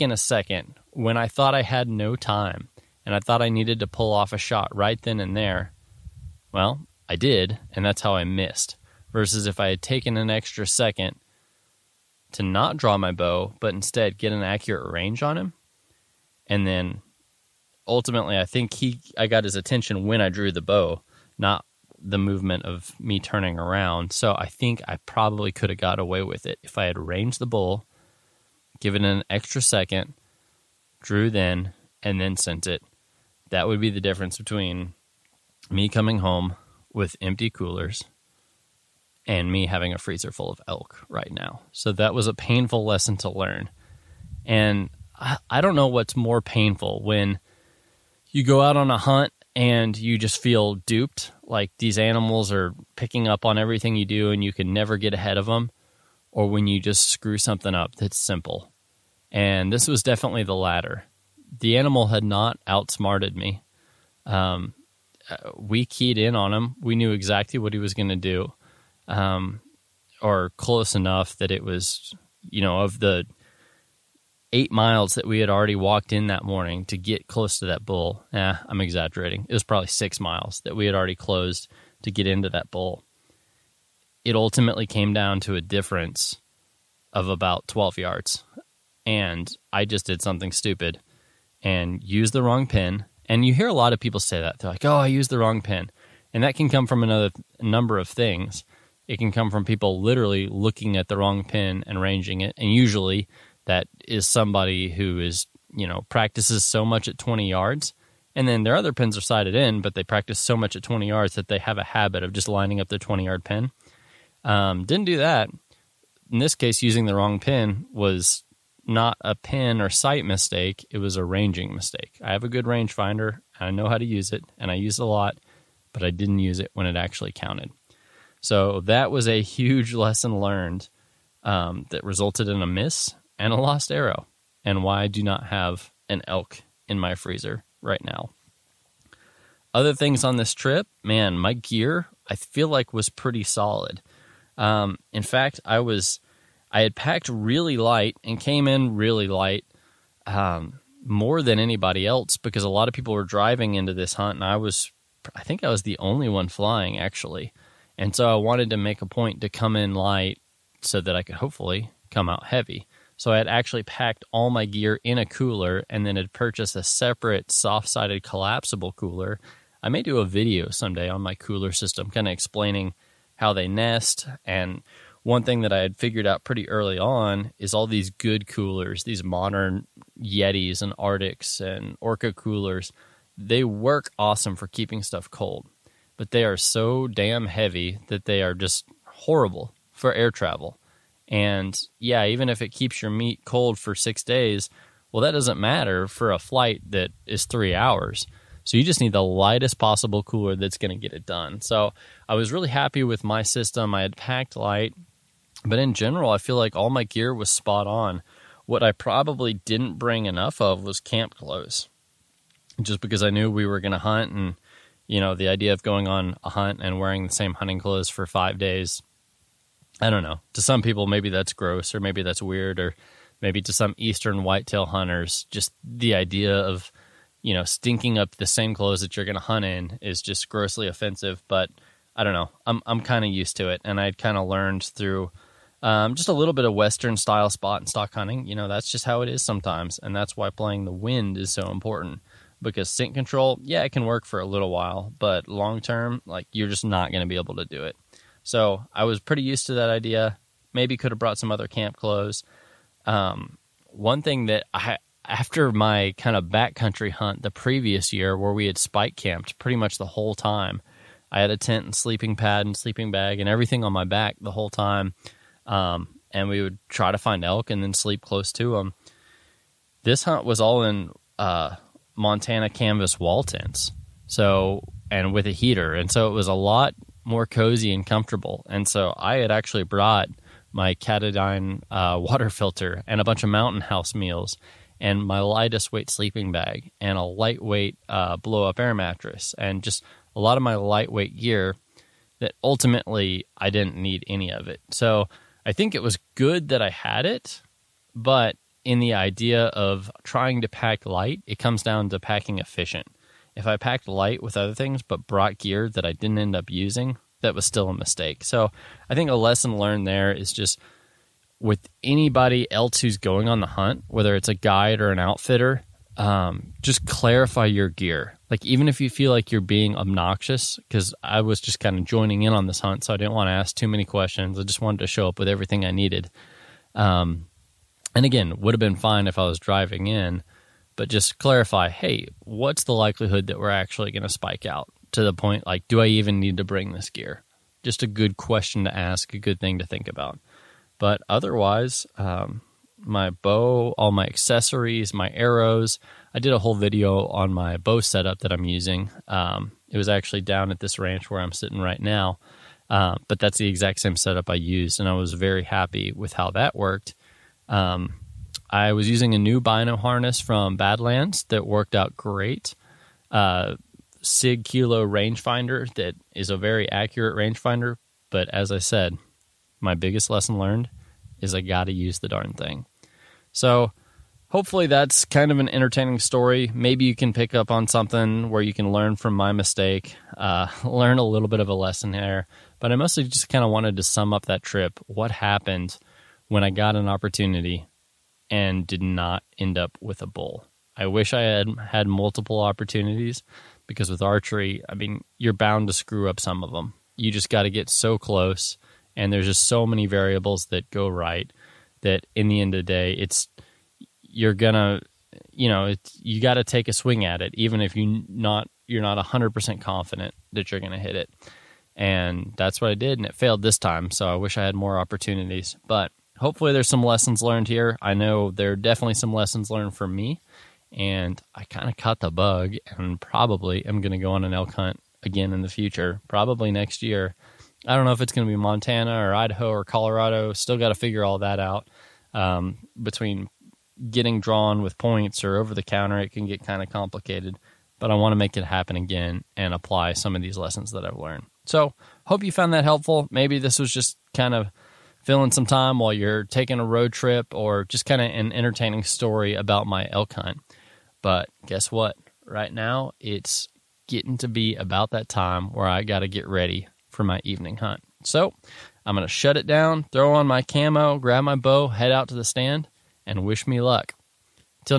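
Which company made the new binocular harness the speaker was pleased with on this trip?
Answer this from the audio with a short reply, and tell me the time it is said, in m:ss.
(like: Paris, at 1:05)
Badlands, at 6:00.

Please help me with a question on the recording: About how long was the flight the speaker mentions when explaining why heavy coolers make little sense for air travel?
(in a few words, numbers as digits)
three hours.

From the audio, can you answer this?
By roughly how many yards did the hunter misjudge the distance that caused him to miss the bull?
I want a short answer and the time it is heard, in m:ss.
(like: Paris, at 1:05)
12 yards, at 1:27.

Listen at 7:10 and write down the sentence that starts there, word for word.
Still got to figure all that out um, between getting drawn with points or over the counter.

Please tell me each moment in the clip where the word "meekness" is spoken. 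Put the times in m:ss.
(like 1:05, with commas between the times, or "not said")
not said.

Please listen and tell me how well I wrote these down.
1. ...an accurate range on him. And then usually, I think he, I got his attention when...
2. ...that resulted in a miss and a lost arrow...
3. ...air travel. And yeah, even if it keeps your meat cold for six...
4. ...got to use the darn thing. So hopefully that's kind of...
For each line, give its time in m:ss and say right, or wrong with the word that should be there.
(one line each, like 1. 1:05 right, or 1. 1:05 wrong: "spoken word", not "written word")
1. 0:14 wrong: "ultimately", not "usually"
2. 2:11 right
3. 3:10 right
4. 6:11 right.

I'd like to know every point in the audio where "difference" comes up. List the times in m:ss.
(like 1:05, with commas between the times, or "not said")
0:34, 1:25.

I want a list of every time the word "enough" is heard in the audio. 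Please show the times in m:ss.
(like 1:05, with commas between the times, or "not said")
1:10, 3:30.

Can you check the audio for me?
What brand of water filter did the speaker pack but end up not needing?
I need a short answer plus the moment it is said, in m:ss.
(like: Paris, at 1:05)
Katadyn, at 4:40.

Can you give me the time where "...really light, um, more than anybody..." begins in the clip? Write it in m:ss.
2:28.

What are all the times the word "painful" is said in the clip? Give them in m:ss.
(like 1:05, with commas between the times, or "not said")
0:42, 0:46.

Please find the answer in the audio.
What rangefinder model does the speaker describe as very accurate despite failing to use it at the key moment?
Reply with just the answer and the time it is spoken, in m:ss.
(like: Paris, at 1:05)
Sig Kilo, at 6:04.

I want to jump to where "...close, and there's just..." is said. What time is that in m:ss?
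6:38.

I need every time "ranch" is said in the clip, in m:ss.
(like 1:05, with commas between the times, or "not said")
5:50.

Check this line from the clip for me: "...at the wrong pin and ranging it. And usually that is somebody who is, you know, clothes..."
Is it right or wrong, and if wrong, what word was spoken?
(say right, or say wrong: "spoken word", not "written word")
wrong: "practices", not "clothes".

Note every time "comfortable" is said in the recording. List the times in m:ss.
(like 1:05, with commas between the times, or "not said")
4:38.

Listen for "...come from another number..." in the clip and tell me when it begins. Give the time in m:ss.
1:36.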